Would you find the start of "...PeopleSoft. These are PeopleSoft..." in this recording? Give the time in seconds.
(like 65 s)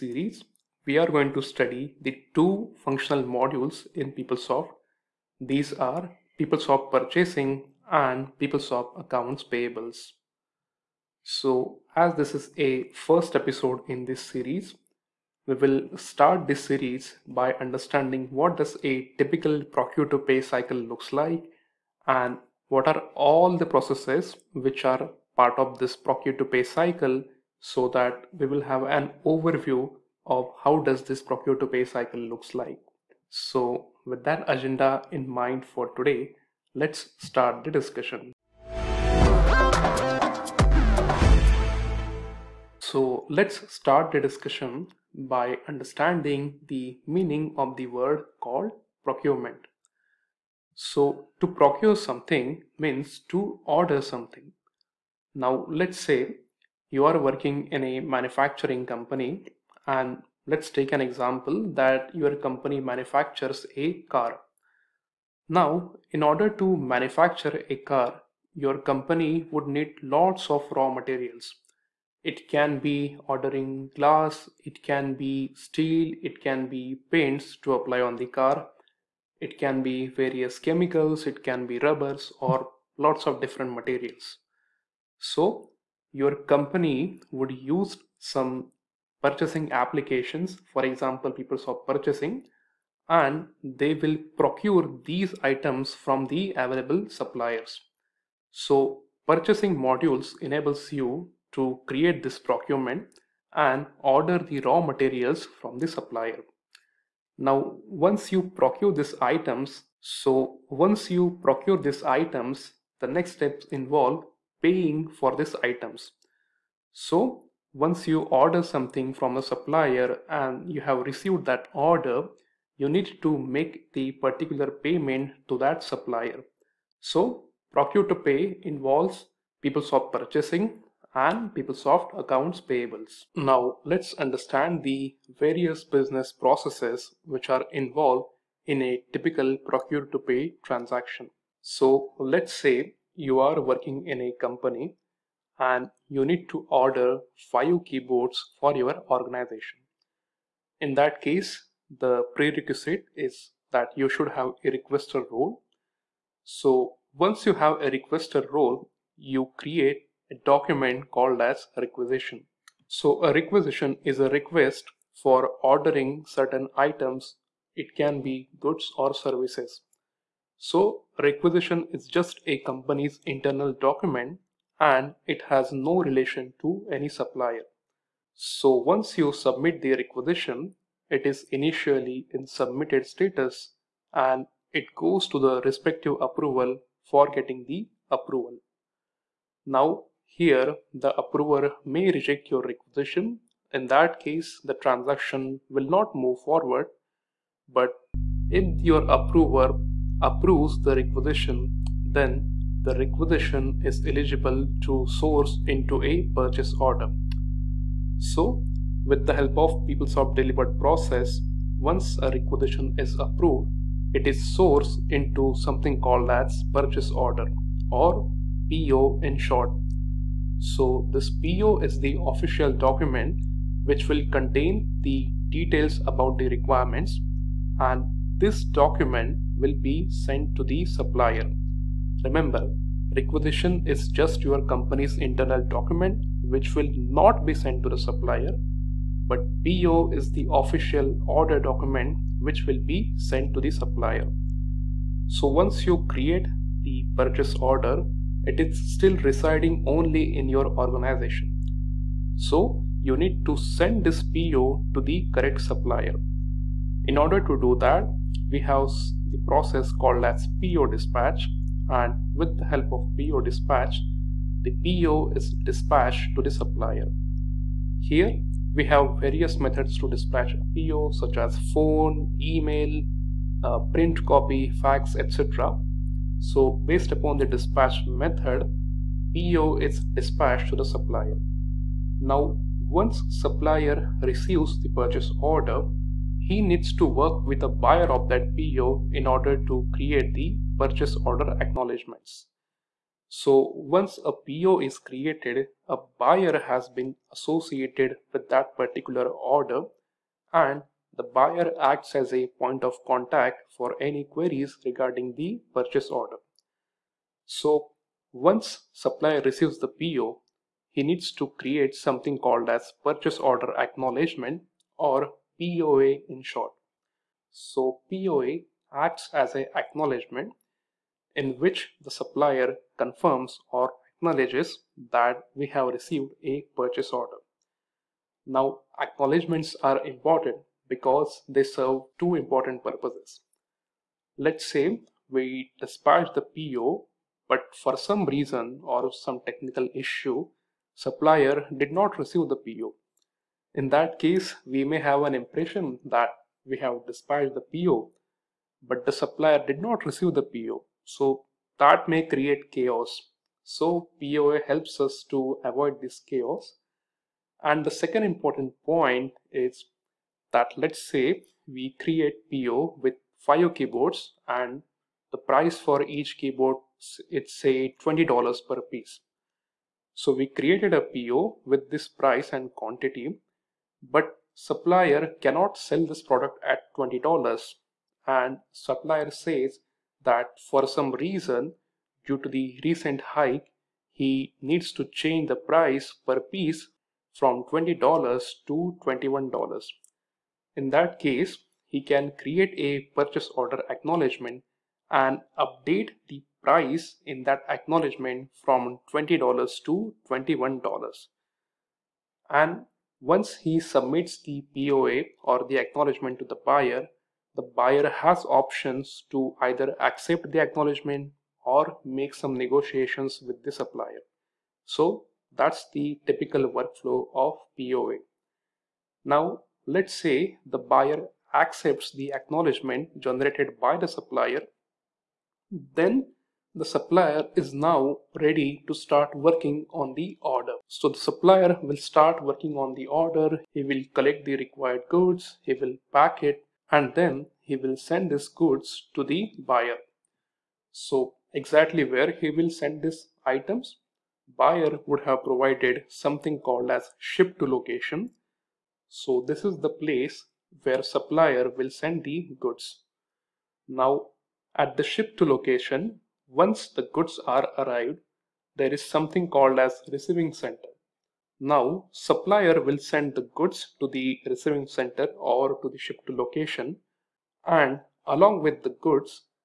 4 s.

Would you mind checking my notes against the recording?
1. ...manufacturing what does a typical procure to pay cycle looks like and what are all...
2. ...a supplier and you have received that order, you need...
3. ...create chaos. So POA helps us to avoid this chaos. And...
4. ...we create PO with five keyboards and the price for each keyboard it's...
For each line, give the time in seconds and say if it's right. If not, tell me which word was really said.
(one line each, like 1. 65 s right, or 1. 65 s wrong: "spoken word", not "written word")
1. 17 s wrong: "understanding", not "manufacturing"
2. 119 s right
3. 352 s right
4. 361 s right.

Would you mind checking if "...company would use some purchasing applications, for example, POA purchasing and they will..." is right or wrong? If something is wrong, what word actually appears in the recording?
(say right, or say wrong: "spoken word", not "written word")
wrong: "PeopleSoft", not "POA".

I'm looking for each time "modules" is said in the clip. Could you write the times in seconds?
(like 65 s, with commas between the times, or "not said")
3 s, 99 s.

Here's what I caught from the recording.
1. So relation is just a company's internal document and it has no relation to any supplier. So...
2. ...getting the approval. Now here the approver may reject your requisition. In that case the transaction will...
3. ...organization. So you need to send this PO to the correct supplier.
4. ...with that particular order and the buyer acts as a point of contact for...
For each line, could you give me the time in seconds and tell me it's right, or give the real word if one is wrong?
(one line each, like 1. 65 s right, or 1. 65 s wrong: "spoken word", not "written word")
1. 170 s wrong: "requisition", not "relation"
2. 187 s right
3. 250 s right
4. 298 s right.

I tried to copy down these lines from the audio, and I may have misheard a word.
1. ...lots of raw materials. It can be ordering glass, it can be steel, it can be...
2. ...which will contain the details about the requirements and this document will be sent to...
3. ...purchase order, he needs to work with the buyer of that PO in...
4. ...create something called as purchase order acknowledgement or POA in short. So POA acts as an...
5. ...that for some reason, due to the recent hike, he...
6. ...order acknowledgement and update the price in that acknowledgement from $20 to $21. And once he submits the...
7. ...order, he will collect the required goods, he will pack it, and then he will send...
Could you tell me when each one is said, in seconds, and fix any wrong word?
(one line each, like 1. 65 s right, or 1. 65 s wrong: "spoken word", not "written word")
1. 70 s right
2. 223 s right
3. 284 s right
4. 311 s right
5. 380 s right
6. 393 s right
7. 433 s right.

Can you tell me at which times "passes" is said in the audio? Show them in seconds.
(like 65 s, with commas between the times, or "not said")
not said.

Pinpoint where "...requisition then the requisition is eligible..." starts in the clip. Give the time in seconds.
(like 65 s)
200 s.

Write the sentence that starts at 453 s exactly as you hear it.
Now at the ship to location, once the goods are arrived, there is something called as receiving center.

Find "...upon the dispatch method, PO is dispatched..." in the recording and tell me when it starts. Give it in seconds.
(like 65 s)
277 s.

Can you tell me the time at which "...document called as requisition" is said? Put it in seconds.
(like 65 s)
160 s.